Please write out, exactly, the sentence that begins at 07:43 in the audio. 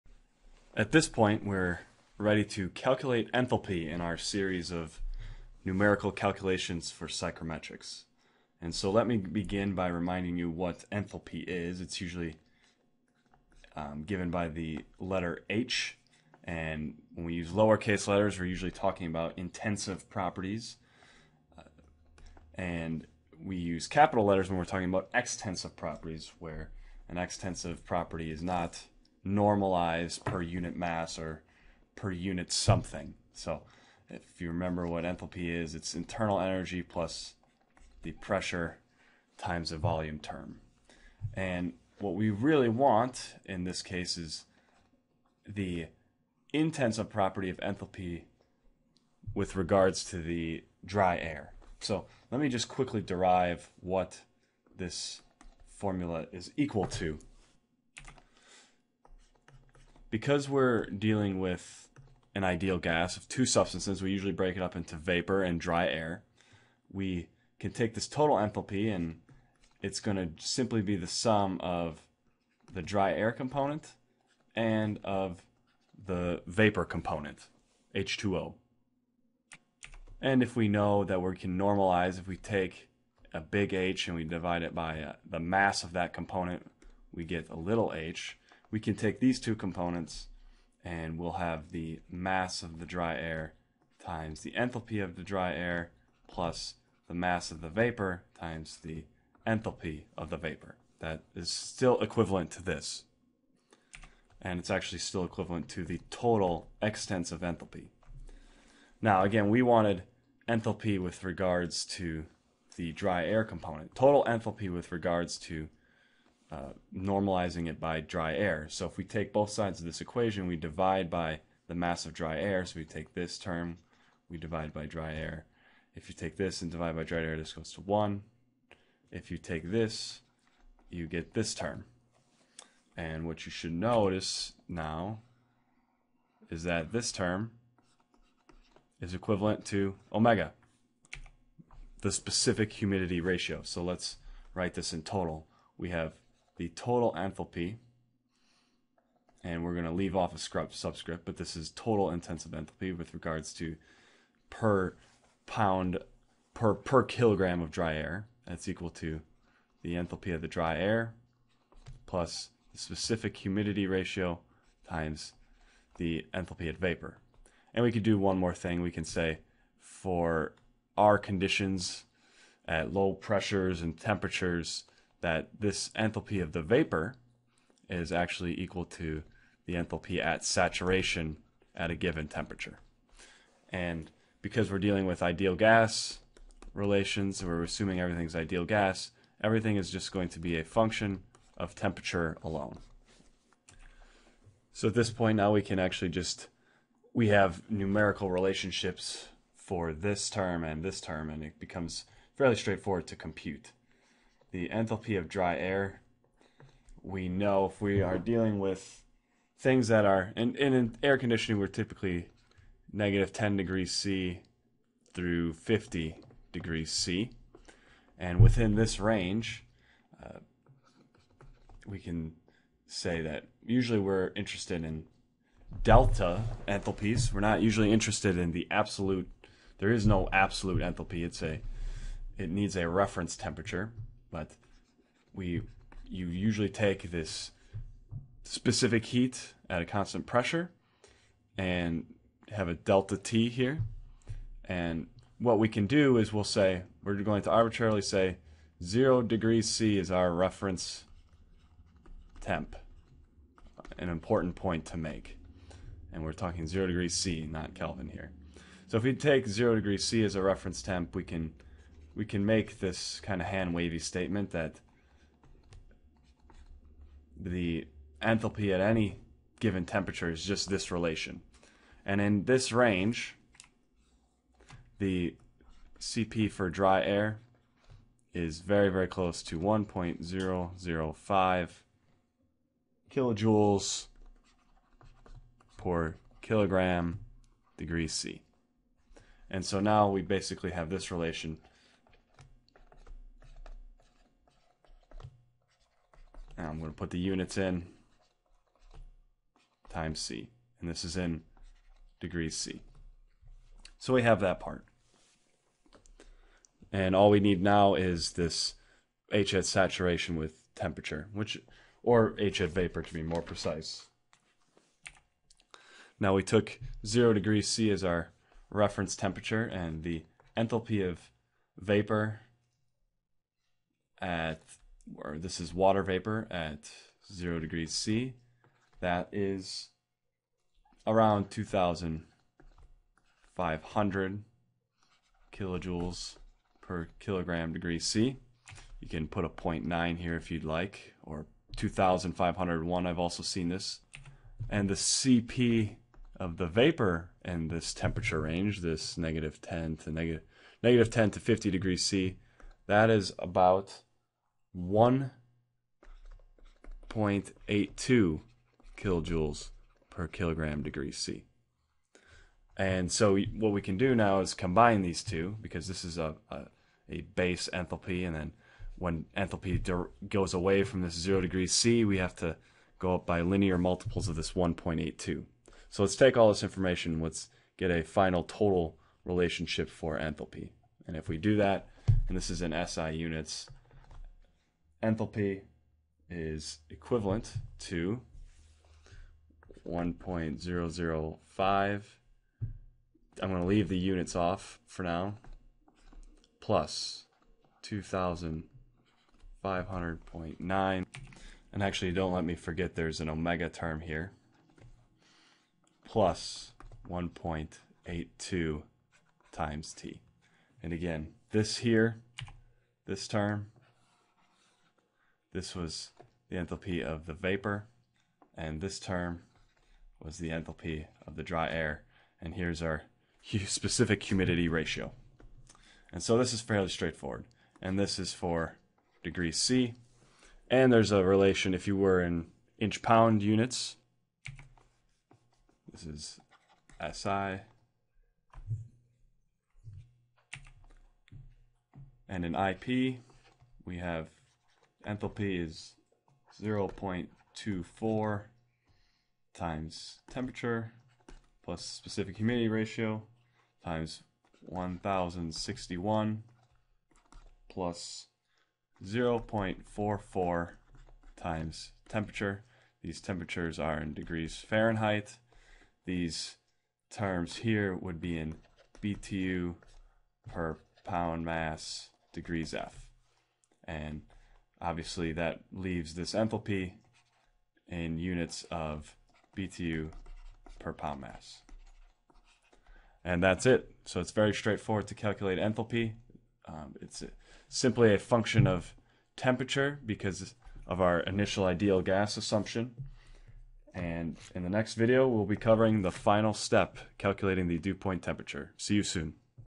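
These temperatures are in degrees Fahrenheit.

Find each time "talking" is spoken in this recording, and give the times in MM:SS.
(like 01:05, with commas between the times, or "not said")
00:18, 00:24, 04:16.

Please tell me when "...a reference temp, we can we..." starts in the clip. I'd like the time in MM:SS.
04:20.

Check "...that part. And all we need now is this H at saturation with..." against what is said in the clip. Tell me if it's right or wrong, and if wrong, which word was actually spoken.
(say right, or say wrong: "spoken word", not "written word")
right.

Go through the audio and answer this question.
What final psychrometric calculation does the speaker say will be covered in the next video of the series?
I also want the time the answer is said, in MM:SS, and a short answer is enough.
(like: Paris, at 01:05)
dew point temperature, at 08:17.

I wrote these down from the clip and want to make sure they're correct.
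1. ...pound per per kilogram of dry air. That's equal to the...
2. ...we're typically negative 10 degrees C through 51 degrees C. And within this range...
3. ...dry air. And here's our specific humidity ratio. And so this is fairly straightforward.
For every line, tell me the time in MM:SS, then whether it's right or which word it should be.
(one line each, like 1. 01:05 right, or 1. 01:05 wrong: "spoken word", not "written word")
1. 02:35 right
2. 03:31 wrong: "50", not "51"
3. 07:01 right.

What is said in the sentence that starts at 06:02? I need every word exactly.
And so what we can do now is combine these two because this is a, a, a base enthalpy.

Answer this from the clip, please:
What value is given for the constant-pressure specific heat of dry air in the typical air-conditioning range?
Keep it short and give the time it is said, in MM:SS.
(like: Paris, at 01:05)
1.005 kJ/kg°C, at 04:39.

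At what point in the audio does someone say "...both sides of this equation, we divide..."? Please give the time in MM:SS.
01:59.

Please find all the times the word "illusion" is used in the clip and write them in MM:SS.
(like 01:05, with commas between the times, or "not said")
not said.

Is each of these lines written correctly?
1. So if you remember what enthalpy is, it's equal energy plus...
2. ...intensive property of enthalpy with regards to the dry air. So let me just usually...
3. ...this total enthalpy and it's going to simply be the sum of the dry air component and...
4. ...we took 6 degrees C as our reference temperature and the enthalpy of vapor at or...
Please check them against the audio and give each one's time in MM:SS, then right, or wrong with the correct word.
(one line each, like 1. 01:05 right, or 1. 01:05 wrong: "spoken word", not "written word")
1. 00:33 wrong: "internal", not "equal"
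2. 00:46 wrong: "quickly", not "usually"
3. 01:07 right
4. 05:16 wrong: "0", not "6".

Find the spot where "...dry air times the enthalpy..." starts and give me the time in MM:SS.
01:32.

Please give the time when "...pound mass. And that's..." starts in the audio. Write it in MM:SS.
08:00.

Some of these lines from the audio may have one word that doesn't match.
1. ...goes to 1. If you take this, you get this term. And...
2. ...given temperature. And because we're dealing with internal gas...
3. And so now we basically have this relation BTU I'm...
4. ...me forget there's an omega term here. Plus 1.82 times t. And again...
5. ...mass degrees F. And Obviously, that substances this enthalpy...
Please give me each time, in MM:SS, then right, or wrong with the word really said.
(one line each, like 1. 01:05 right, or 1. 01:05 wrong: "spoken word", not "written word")
1. 02:07 right
2. 03:01 wrong: "ideal", not "internal"
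3. 04:49 wrong: "And", not "BTU"
4. 06:42 right
5. 07:51 wrong: "leaves", not "substances".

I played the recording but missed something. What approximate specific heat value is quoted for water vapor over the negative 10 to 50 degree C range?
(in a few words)
1.82 kJ/kg°C.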